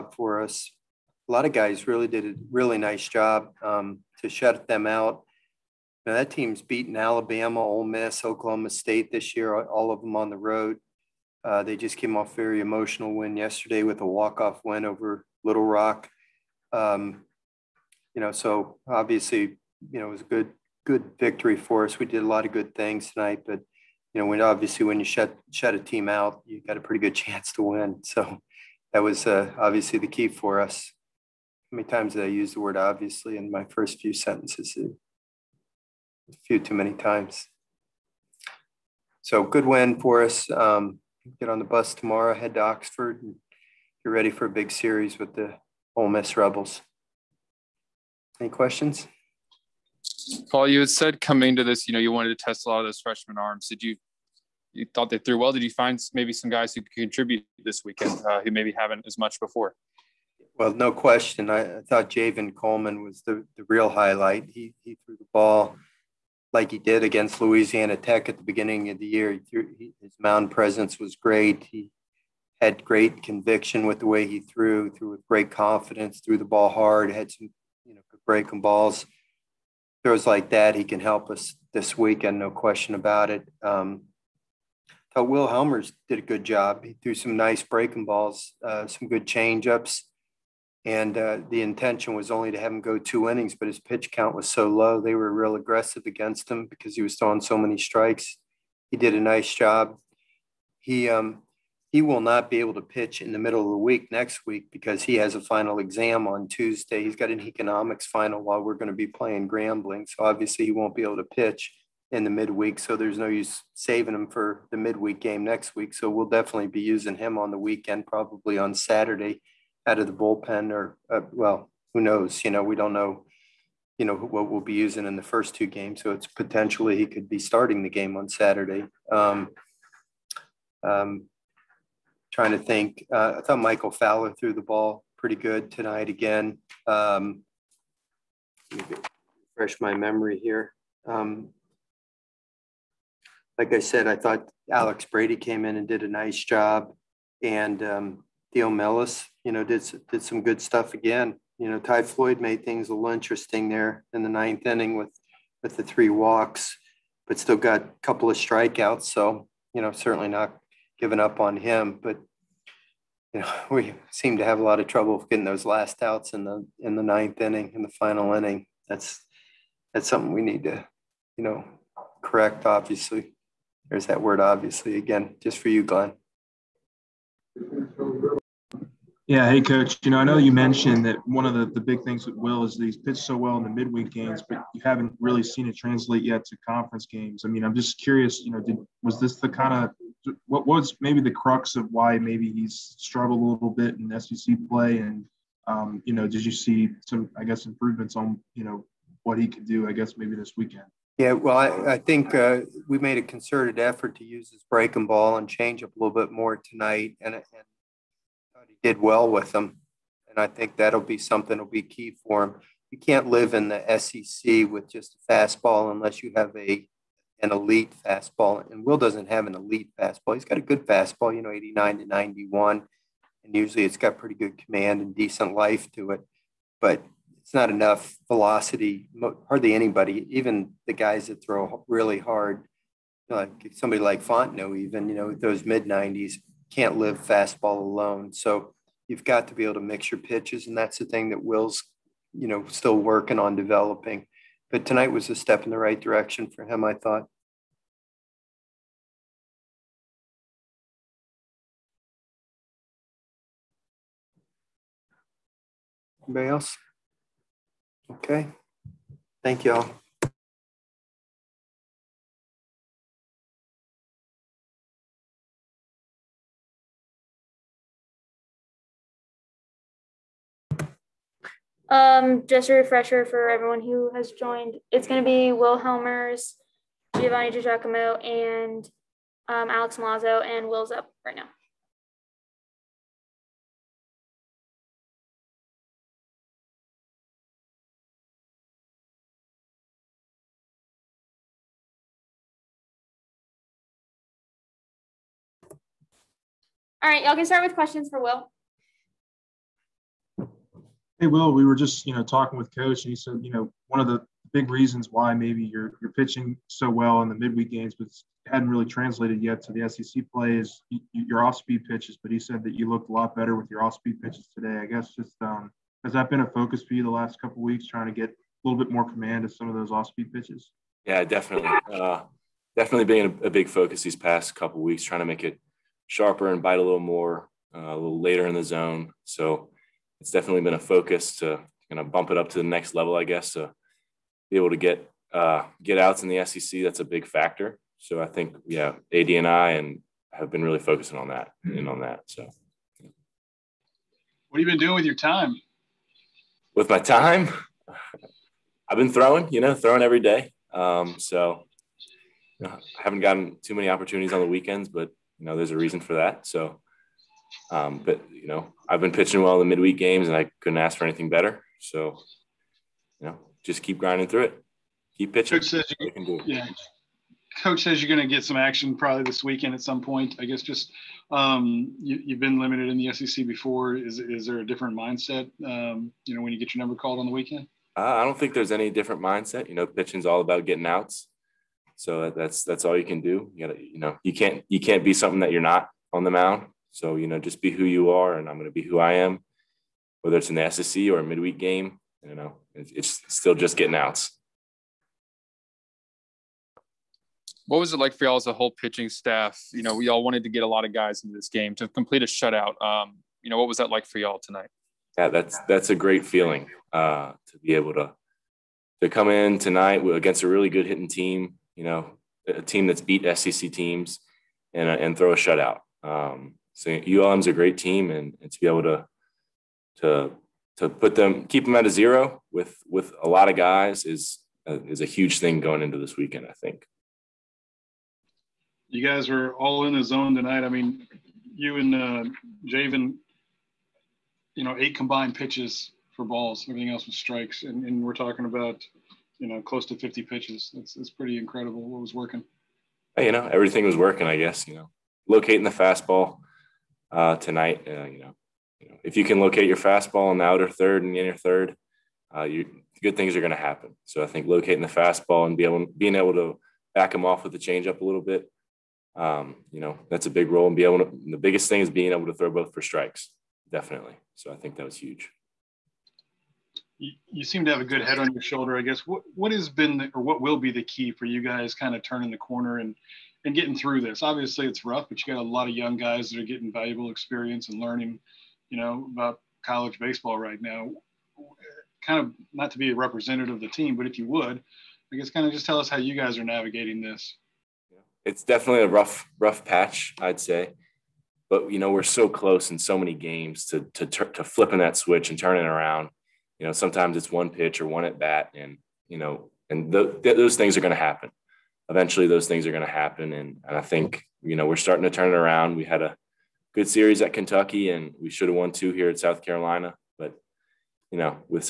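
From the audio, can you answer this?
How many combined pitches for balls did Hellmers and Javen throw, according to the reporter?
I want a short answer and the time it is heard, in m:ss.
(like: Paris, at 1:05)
8, at 7:14.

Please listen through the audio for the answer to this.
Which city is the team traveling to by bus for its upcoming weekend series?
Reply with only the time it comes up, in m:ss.
0:42.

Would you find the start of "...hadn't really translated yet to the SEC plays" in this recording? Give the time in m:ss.
5:08.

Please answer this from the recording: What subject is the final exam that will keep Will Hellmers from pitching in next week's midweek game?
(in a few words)
Economics.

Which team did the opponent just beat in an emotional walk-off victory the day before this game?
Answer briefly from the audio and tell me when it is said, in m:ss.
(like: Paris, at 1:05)
Little Rock, at 0:15.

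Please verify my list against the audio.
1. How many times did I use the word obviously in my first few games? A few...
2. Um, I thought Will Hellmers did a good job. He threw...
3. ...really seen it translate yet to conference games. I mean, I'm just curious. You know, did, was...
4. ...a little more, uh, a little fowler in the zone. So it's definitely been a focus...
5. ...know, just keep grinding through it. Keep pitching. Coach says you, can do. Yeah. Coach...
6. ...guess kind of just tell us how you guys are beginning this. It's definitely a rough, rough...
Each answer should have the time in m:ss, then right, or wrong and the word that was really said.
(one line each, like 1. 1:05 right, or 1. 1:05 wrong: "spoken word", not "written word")
1. 0:31 wrong: "sentences", not "games"
2. 1:23 right
3. 3:05 right
4. 5:26 wrong: "later", not "fowler"
5. 6:03 right
6. 8:05 wrong: "navigating", not "beginning".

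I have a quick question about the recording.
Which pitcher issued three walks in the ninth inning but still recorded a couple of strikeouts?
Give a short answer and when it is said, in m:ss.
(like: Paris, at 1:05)
Ty Floyd, at 2:31.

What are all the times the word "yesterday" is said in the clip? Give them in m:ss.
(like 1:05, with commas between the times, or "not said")
0:13.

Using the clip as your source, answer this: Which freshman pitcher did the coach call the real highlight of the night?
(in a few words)
Javen Coleman.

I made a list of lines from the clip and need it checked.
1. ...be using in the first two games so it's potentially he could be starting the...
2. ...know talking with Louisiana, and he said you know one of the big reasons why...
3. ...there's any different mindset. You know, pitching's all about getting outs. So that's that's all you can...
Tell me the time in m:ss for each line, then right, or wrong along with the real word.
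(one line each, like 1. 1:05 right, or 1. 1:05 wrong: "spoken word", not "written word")
1. 2:04 right
2. 5:02 wrong: "Coach", not "Louisiana"
3. 6:18 right.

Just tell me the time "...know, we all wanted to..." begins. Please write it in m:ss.
6:39.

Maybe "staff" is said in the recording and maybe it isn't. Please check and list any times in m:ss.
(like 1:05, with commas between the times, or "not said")
6:39.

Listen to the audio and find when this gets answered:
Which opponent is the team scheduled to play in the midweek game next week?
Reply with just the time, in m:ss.
1:49.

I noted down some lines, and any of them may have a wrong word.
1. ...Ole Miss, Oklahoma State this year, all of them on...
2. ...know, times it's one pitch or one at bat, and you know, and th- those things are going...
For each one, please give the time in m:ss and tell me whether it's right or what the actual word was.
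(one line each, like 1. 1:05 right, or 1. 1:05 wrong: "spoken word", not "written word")
1. 0:07 right
2. 8:16 wrong: "sometimes", not "times".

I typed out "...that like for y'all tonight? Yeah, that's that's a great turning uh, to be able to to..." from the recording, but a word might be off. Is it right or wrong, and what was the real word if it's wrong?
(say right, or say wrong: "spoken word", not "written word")
wrong: "feeling", not "turning".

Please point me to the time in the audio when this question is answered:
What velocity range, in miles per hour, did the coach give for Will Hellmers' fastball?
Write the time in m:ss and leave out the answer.
3:41.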